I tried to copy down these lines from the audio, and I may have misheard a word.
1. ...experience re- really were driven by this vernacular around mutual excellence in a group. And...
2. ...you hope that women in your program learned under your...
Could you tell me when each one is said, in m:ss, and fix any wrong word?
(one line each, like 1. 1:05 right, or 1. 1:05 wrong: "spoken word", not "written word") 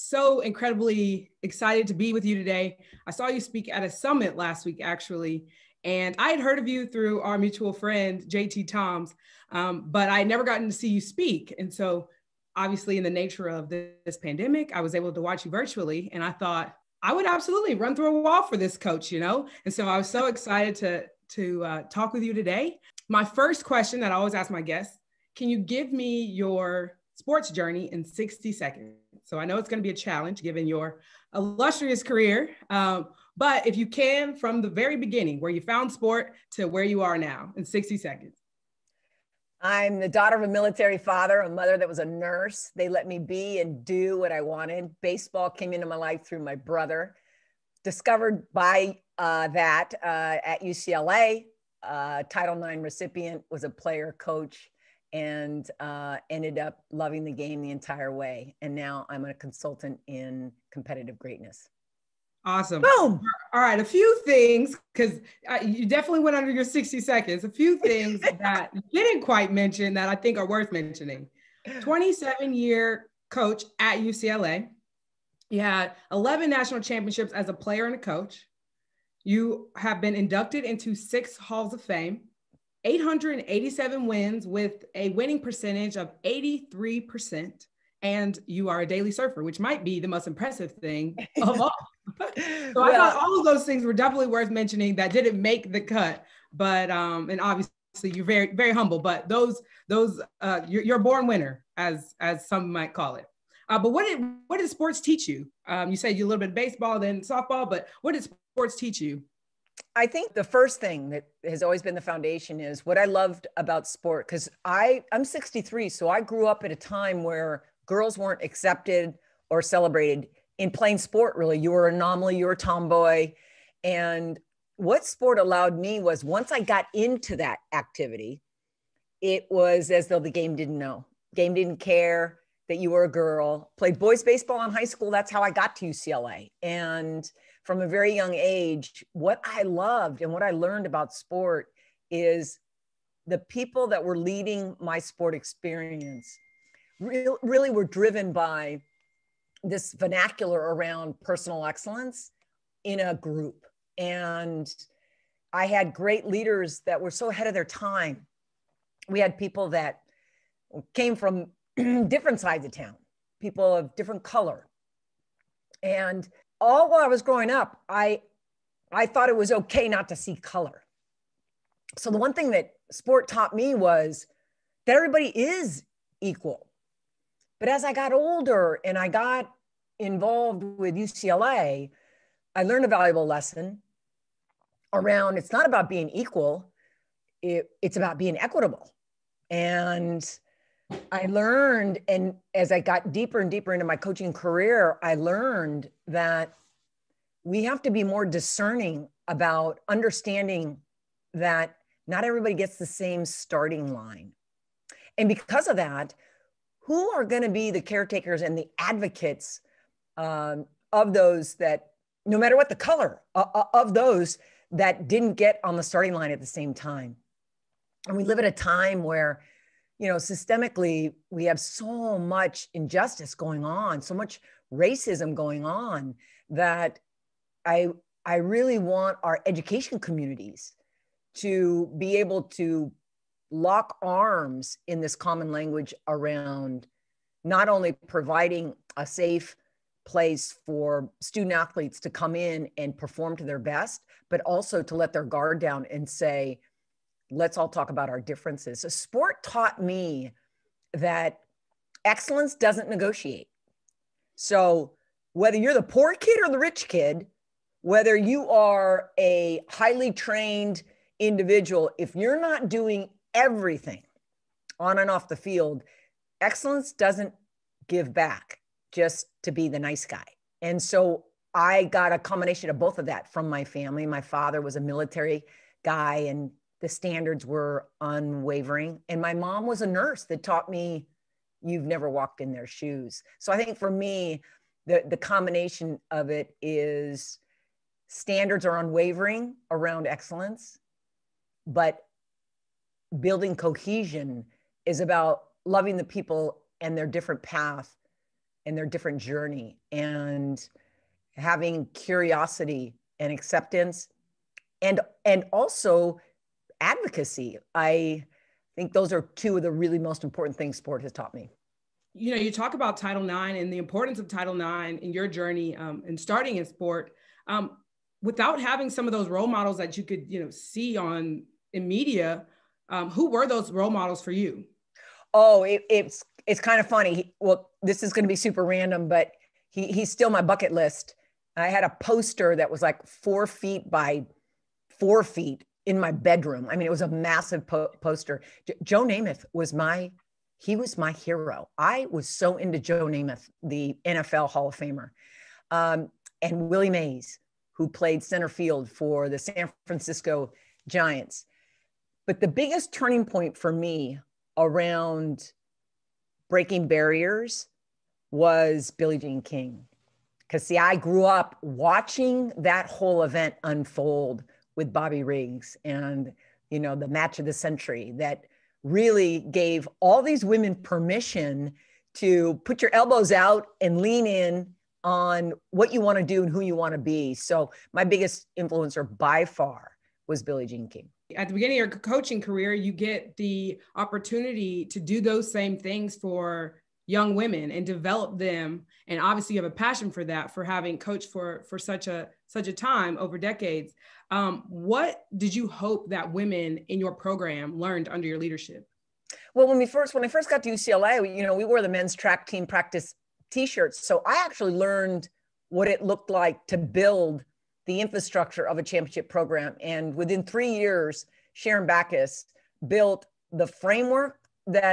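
1. 2:25 wrong: "personal", not "mutual"
2. 6:35 right.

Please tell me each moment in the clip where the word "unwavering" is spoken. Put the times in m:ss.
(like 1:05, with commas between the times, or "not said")
4:38, 4:48.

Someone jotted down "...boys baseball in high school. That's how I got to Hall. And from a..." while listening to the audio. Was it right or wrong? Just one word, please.
wrong.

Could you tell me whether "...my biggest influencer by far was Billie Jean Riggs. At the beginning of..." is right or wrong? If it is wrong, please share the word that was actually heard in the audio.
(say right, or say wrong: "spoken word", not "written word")
wrong: "King", not "Riggs".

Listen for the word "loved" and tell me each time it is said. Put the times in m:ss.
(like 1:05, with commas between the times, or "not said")
1:53, 2:19.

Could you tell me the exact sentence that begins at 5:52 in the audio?
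But the biggest turning point for me around breaking barriers was Billie Jean King.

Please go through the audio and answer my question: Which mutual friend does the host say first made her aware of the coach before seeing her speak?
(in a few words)
JT Toms.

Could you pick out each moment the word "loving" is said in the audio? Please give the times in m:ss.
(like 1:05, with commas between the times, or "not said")
0:56, 4:55.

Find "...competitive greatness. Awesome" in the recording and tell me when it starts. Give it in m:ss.
1:00.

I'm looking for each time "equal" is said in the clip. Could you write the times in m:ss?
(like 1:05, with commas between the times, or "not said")
2:56, 3:06.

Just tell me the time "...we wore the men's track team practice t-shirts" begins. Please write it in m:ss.
6:41.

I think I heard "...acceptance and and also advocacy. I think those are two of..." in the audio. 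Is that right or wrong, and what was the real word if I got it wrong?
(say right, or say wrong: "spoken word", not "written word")
right.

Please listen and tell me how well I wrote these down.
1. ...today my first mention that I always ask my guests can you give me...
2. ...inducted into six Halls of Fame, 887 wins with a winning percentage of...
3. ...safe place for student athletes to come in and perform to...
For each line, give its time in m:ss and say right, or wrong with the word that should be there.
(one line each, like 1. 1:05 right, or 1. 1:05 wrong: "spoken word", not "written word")
1. 0:22 wrong: "question", not "mention"
2. 1:20 right
3. 3:59 right.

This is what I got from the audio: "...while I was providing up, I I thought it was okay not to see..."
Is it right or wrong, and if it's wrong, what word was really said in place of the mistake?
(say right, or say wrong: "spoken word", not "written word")
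wrong: "growing", not "providing".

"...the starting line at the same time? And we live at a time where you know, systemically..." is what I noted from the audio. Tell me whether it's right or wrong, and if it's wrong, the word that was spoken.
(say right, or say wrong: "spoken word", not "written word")
right.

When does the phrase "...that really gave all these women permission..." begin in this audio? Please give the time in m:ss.
6:08.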